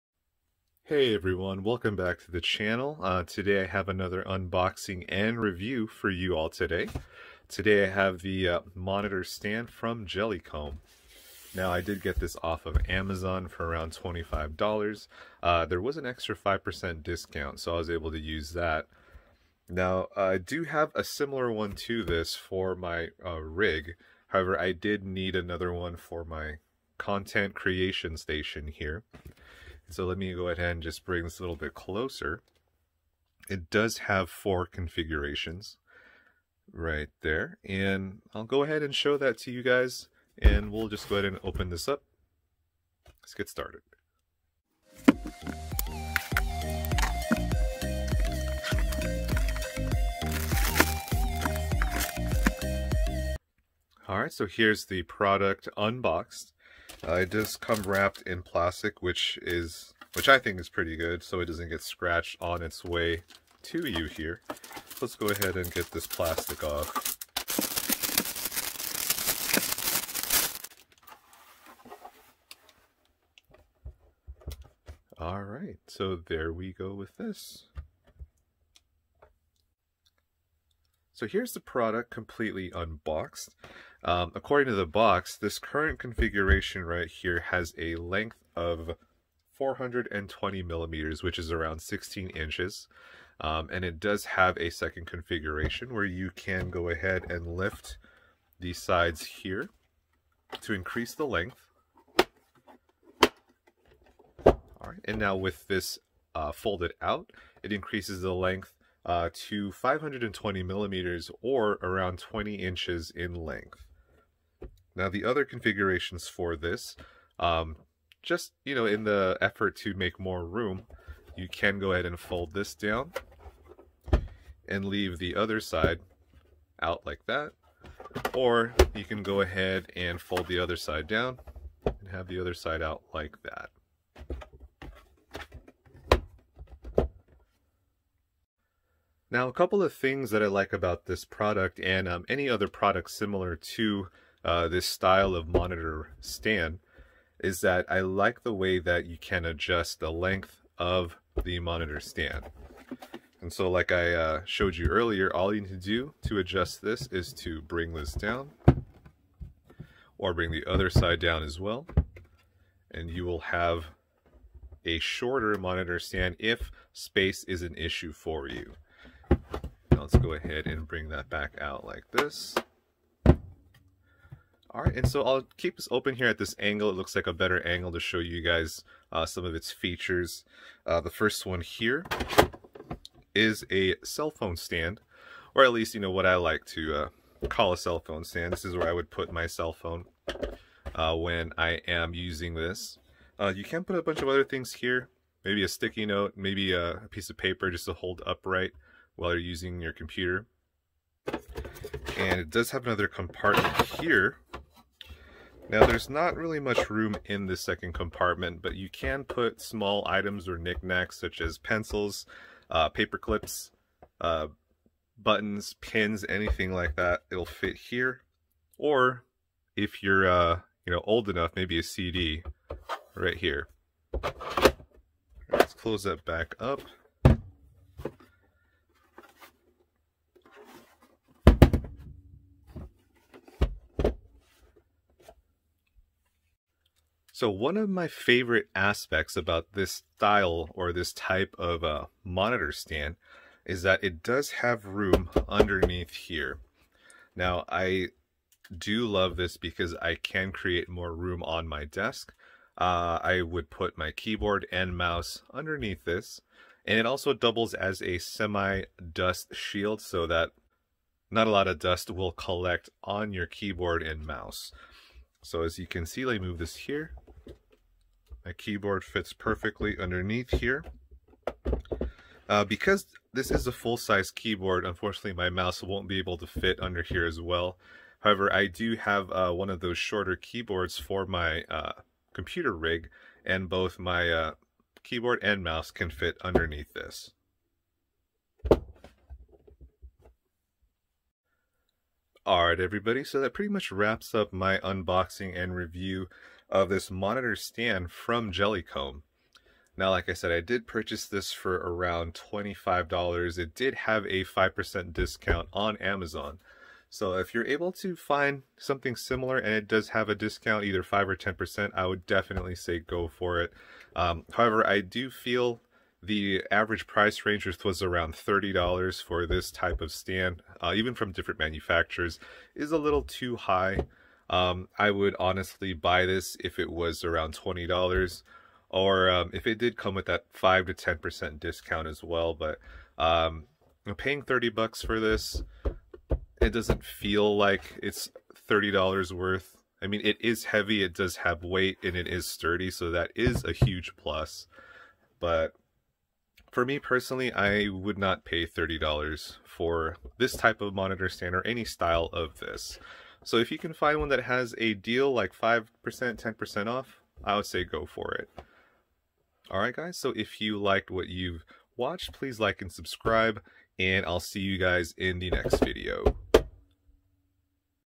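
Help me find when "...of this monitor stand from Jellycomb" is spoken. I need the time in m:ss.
4:56.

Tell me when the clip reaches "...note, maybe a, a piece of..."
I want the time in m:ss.
3:16.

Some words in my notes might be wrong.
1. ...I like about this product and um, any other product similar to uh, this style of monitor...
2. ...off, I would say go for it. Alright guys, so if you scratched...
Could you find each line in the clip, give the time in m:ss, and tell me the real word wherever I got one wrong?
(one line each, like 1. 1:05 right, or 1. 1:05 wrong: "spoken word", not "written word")
1. 2:20 right
2. 5:56 wrong: "liked", not "scratched".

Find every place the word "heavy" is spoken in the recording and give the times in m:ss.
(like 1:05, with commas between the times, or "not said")
5:40.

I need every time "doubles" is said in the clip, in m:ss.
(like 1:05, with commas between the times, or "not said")
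4:17.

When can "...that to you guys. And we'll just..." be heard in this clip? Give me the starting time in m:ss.
0:39.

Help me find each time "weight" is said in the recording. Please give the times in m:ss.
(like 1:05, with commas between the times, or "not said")
5:41.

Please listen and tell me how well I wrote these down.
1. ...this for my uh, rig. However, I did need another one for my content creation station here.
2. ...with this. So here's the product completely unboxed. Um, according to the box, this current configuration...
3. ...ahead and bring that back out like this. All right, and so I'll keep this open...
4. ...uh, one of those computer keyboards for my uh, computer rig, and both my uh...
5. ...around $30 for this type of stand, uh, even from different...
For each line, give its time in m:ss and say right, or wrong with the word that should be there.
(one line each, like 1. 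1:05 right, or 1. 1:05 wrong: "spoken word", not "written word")
1. 0:22 right
2. 1:16 right
3. 2:50 right
4. 4:39 wrong: "shorter", not "computer"
5. 5:18 right.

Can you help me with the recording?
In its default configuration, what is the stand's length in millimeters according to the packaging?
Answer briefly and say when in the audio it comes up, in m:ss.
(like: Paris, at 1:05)
420 millimeters, at 1:29.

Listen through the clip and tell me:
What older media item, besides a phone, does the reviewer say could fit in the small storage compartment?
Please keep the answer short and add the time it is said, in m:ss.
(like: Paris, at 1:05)
a CD, at 3:41.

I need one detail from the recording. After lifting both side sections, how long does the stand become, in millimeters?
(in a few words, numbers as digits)
520 millimeters.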